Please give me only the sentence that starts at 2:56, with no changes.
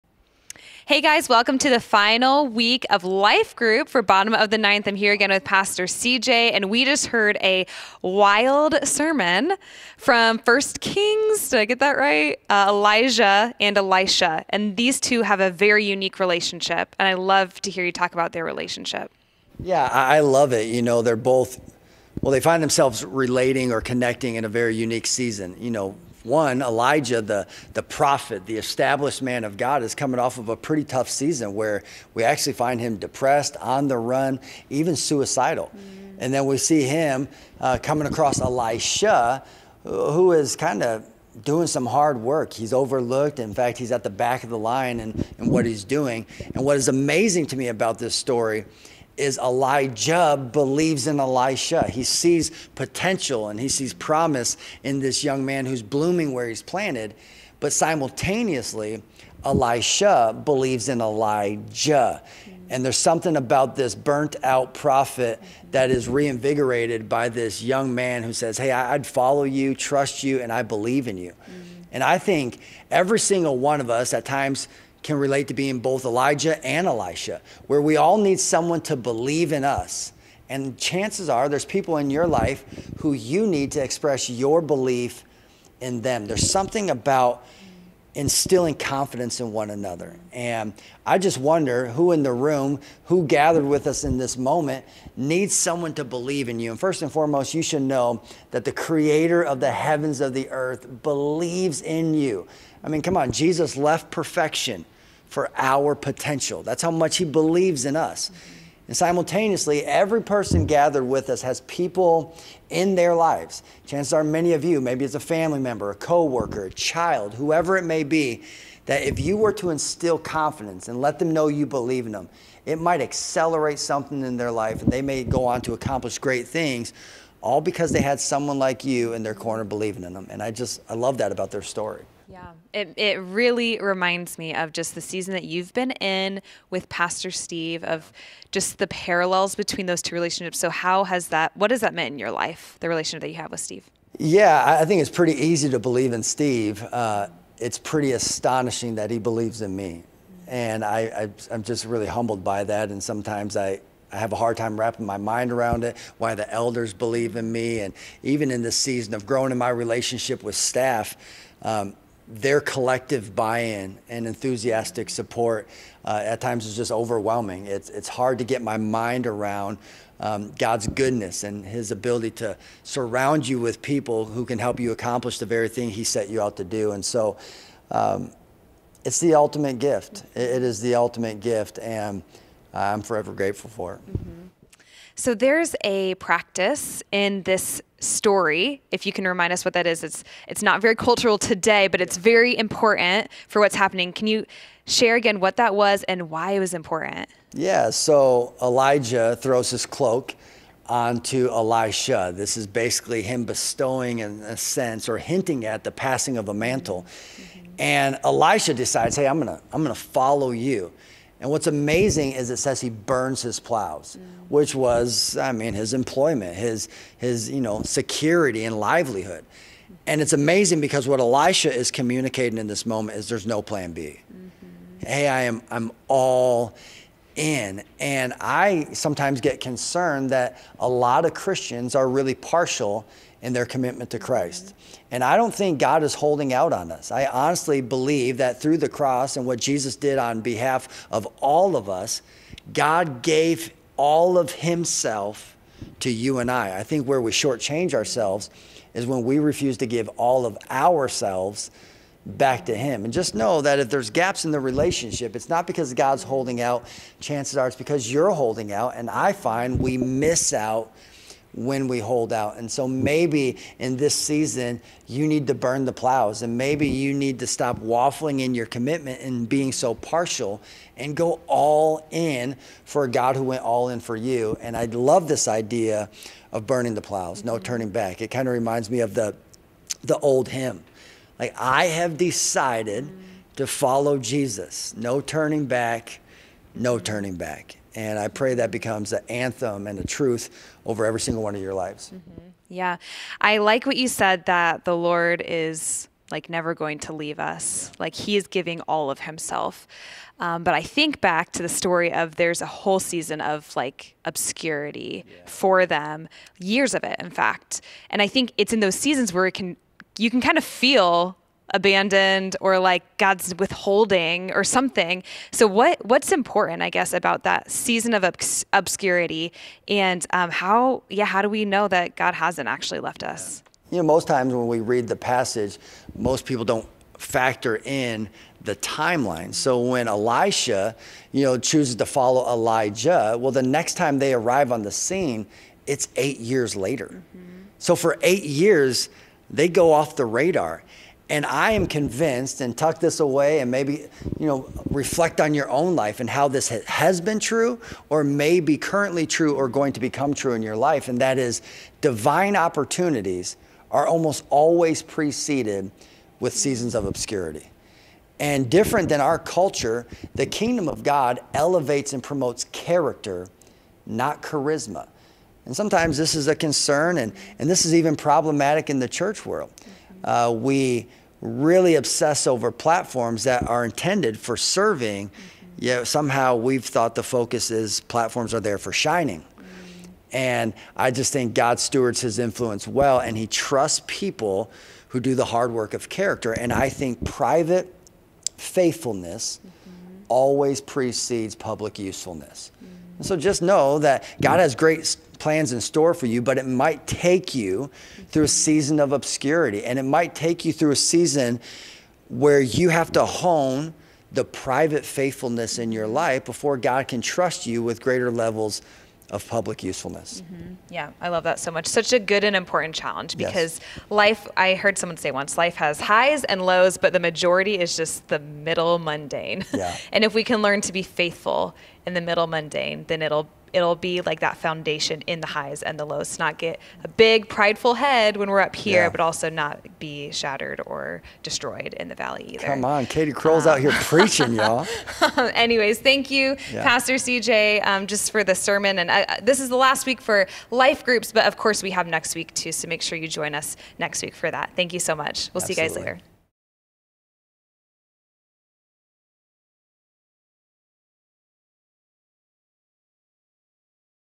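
And so um, it's the ultimate gift.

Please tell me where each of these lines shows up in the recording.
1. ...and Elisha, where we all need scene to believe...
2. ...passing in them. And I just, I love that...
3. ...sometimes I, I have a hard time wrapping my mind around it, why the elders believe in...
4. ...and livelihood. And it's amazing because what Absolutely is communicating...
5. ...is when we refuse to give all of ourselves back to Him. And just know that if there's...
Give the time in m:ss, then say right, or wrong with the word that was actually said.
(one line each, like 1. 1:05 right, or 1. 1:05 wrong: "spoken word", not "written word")
1. 1:16 wrong: "someone", not "scene"
2. 2:09 wrong: "believing", not "passing"
3. 2:33 right
4. 3:38 wrong: "Elisha", not "Absolutely"
5. 4:08 right.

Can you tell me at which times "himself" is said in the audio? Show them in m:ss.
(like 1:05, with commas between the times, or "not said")
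4:04, 4:59.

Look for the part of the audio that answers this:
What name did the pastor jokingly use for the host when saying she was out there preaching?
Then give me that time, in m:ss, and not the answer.
7:13.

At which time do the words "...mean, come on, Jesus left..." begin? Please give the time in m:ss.
1:42.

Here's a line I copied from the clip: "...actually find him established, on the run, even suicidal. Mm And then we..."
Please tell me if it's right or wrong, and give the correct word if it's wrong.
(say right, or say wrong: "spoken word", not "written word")
wrong: "depressed", not "established".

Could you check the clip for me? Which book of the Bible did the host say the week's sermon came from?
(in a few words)
First Kings.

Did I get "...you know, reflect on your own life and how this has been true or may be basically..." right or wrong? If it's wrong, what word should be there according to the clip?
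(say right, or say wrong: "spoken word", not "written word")
wrong: "currently", not "basically".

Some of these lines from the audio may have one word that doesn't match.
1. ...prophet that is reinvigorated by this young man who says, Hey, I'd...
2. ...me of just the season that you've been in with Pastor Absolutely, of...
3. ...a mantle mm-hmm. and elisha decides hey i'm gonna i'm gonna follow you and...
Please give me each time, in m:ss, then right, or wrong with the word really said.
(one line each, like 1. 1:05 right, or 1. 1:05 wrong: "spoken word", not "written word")
1. 1:04 right
2. 2:14 wrong: "Steve", not "Absolutely"
3. 3:26 right.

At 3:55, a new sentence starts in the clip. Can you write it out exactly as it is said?
And I don't think God is holding out on us.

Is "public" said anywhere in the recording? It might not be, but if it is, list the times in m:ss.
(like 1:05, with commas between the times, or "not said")
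6:31, 6:49.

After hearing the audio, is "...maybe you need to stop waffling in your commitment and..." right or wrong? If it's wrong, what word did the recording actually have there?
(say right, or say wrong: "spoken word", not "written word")
right.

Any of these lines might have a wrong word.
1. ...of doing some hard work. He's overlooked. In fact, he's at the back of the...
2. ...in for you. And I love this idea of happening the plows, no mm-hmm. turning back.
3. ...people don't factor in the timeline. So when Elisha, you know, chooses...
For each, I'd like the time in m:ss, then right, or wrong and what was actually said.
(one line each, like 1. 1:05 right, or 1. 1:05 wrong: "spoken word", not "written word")
1. 0:40 right
2. 4:33 wrong: "burning", not "happening"
3. 5:26 right.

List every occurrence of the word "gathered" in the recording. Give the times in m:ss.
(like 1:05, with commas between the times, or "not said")
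1:33, 1:50.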